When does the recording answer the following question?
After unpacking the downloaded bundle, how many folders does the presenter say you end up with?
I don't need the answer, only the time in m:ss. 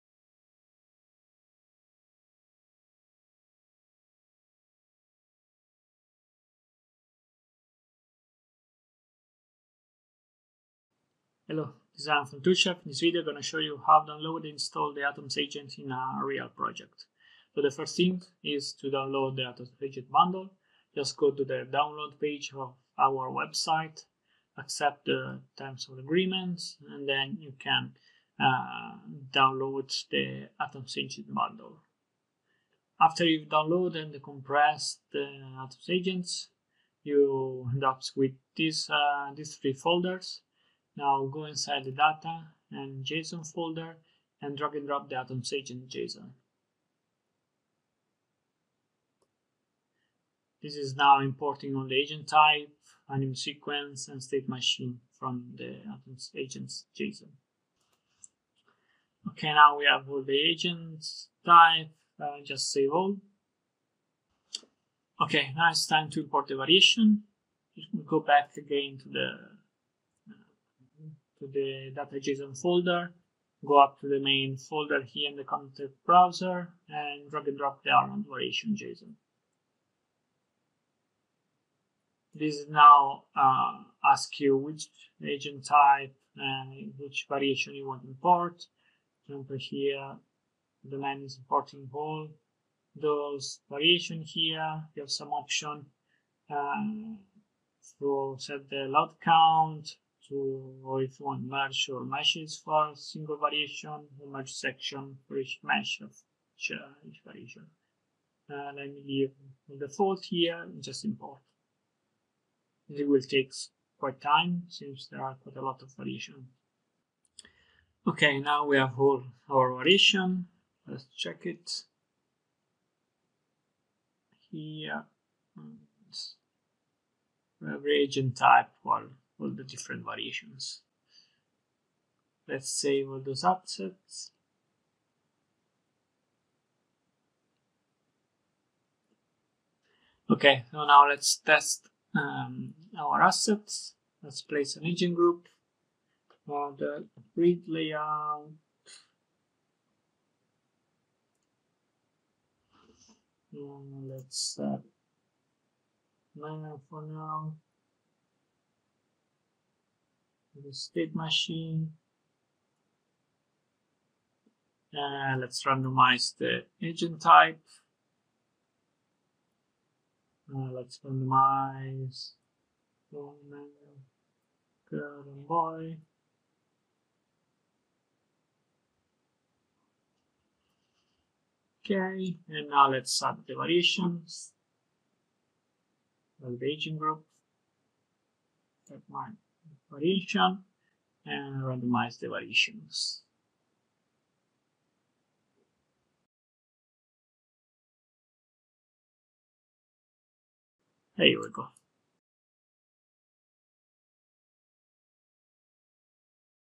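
0:39.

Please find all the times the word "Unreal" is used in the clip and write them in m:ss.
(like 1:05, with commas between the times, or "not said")
0:16.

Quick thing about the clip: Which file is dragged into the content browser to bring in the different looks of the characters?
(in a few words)
Armand variation JSON.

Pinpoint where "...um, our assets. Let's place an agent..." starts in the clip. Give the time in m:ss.
2:22.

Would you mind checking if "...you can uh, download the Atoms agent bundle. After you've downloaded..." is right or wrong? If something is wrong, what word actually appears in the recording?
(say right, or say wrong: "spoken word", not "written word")
right.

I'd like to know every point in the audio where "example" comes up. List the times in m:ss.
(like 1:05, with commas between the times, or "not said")
1:29.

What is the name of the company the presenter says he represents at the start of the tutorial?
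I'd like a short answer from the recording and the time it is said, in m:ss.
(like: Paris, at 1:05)
ToolChef, at 0:12.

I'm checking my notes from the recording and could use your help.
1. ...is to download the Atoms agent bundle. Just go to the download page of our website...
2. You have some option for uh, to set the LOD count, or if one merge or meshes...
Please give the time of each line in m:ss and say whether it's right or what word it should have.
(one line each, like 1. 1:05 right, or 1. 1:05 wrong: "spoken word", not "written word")
1. 0:18 right
2. 1:34 right.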